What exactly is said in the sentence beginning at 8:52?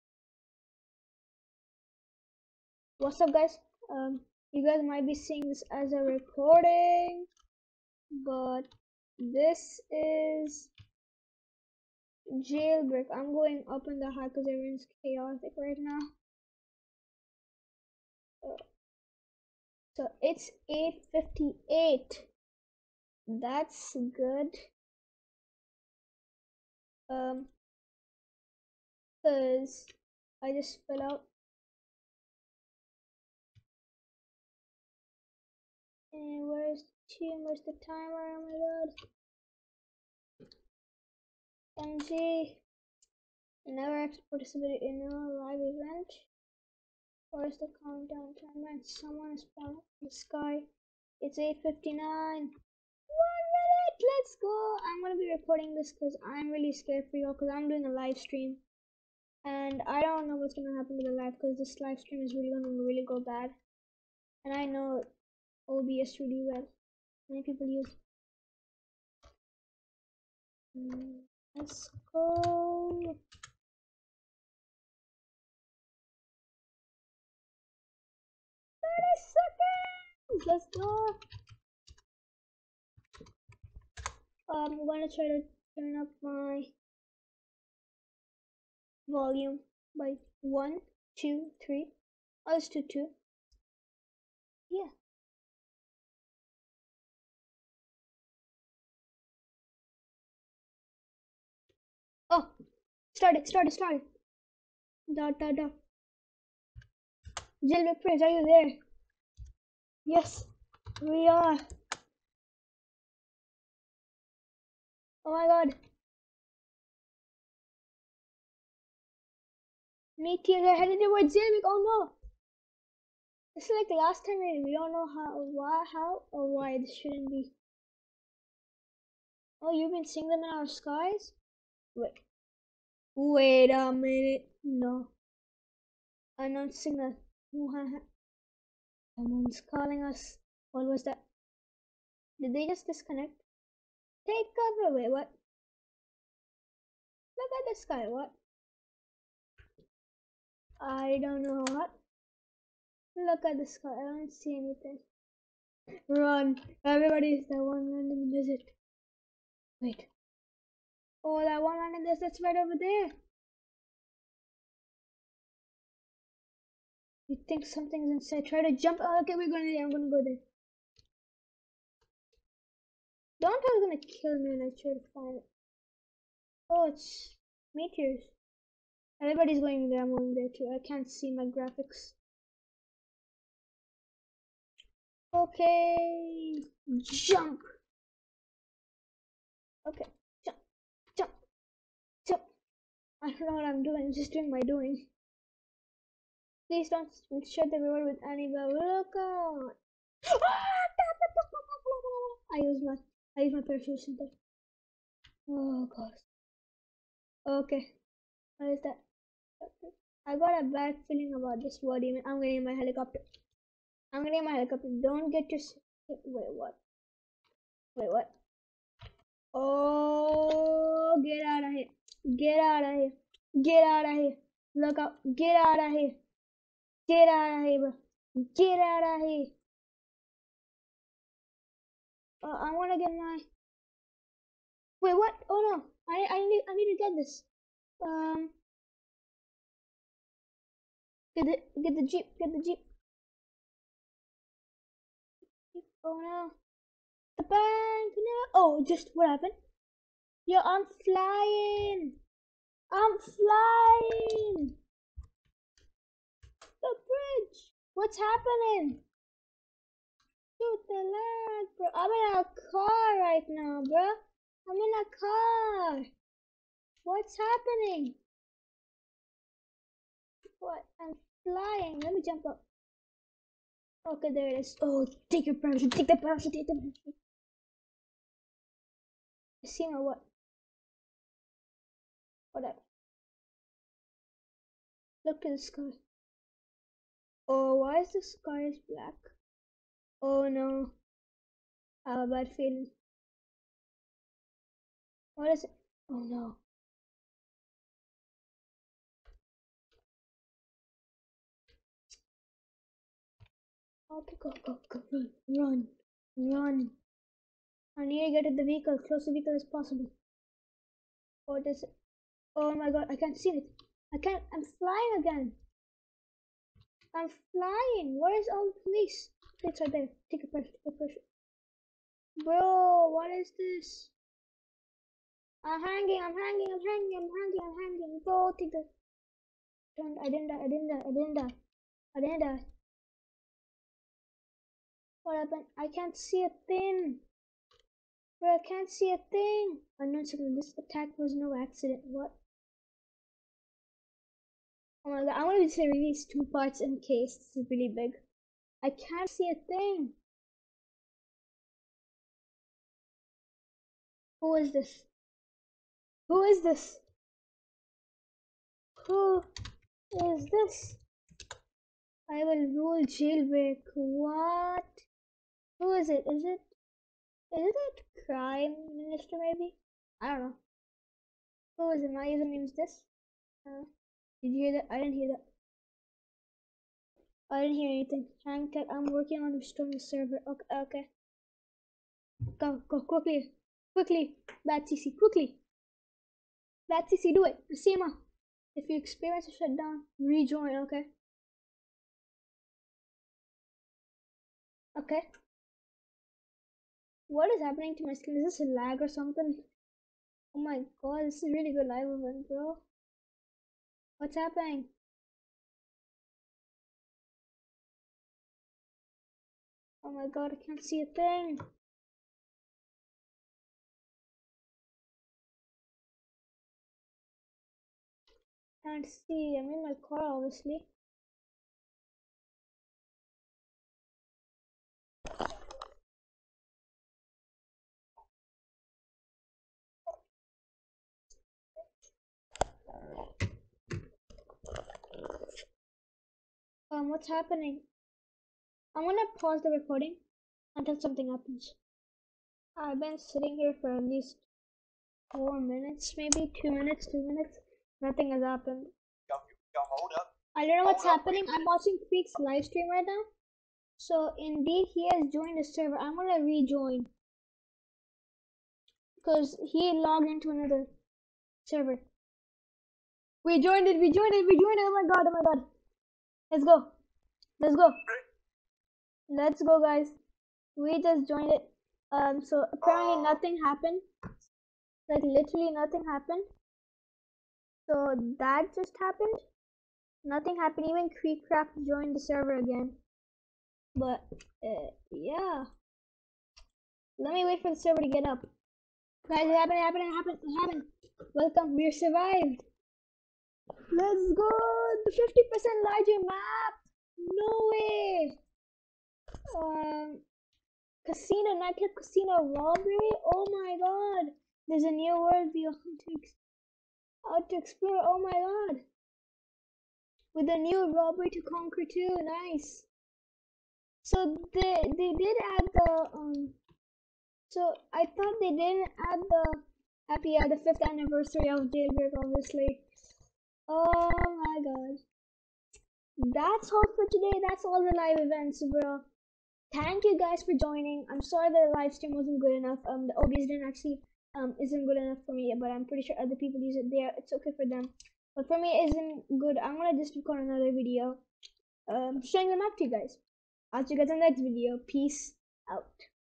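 Um, the OBS didn't actually um isn't good enough for me, but I'm pretty sure other people use it there.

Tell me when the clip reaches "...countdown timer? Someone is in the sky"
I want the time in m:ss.
0:47.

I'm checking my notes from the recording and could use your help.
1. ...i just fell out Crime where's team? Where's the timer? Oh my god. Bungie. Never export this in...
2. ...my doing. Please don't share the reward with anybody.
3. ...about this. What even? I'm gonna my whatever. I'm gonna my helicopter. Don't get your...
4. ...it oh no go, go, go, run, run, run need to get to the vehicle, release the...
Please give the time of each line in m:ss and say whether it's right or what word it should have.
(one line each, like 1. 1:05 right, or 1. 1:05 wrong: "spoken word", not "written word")
1. 0:30 wrong: "And", not "Crime"
2. 3:14 right
3. 3:31 wrong: "helicopter", not "whatever"
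4. 4:55 wrong: "close", not "release".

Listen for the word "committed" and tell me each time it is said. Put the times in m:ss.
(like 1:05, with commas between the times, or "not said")
not said.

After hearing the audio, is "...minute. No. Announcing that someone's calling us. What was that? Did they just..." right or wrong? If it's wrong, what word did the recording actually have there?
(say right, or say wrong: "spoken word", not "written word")
right.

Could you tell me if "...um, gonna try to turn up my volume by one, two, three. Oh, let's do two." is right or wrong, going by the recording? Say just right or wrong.
right.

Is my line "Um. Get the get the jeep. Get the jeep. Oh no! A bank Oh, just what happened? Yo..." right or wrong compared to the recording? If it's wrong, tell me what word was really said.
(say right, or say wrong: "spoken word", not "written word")
right.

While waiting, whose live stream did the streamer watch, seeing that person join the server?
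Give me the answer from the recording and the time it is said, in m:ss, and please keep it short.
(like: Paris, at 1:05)
Freak, at 7:32.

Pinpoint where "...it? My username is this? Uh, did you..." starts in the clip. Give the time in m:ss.
6:12.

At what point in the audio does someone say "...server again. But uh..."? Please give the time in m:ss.
8:02.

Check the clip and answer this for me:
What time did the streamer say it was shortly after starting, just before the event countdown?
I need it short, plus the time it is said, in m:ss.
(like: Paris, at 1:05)
8:58, at 0:20.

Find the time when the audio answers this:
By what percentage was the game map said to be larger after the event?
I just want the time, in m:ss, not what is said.
8:15.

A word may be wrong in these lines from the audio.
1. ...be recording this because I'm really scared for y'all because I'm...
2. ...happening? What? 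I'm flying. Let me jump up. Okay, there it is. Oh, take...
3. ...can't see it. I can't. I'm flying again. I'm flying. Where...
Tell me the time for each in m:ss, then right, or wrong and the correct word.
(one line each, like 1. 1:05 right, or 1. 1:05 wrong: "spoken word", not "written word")
1. 0:55 right
2. 4:27 right
3. 5:13 right.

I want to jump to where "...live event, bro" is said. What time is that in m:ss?
6:41.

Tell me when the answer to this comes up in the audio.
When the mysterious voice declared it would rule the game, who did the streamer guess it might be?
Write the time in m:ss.
6:08.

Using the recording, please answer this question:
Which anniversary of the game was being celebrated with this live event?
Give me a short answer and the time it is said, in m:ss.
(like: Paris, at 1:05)
5th, at 8:40.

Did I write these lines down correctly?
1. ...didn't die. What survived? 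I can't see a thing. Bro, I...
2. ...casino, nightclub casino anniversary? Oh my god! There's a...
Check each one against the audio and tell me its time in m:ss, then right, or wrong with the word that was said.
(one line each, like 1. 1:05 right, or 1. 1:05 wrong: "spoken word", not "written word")
1. 5:32 wrong: "happened", not "survived"
2. 8:21 wrong: "robbery", not "anniversary".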